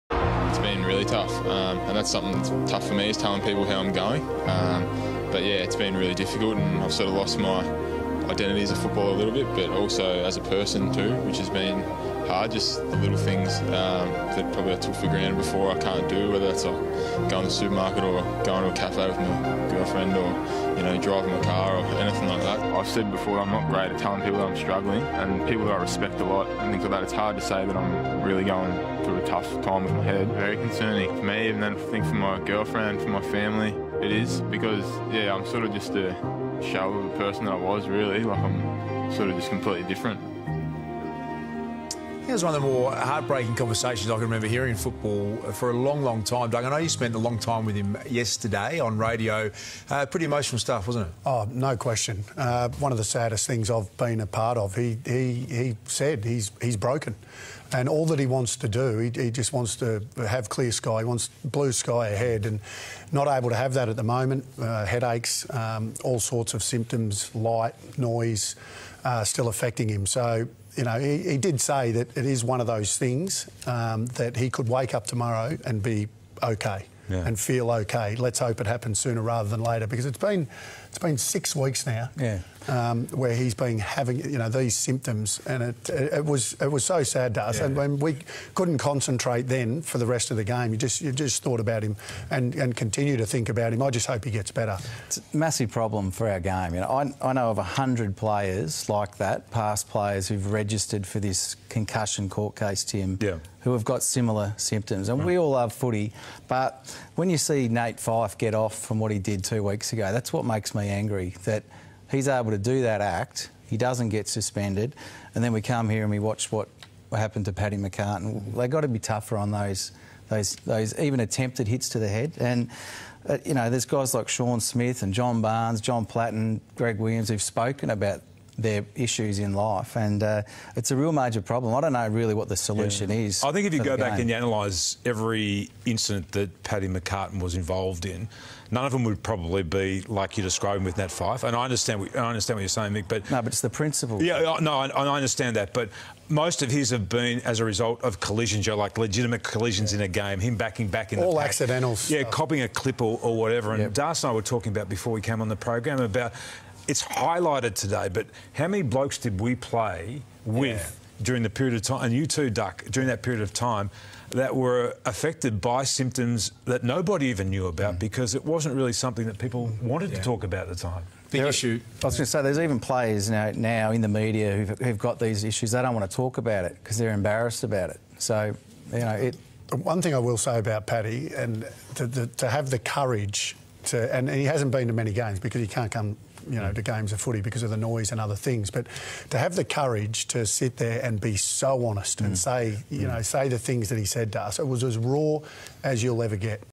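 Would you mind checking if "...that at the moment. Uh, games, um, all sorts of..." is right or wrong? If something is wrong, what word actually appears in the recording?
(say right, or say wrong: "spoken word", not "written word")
wrong: "headaches", not "games".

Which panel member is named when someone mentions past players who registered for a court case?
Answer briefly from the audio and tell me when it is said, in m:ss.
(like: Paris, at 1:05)
Tim, at 1:42.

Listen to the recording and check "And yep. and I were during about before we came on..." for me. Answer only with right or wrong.
wrong.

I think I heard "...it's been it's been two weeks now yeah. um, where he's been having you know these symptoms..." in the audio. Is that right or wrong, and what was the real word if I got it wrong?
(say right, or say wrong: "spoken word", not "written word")
wrong: "six", not "two".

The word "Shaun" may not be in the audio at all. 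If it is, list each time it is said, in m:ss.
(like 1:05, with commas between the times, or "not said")
2:04.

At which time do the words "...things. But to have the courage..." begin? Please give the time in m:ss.
3:08.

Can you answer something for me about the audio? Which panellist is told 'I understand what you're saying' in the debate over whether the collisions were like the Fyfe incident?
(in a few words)
Mick.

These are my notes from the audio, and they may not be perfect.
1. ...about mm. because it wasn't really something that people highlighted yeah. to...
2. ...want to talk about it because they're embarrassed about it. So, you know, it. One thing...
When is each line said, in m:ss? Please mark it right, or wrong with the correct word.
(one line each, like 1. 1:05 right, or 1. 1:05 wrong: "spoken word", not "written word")
1. 2:47 wrong: "wanted", not "highlighted"
2. 2:55 right.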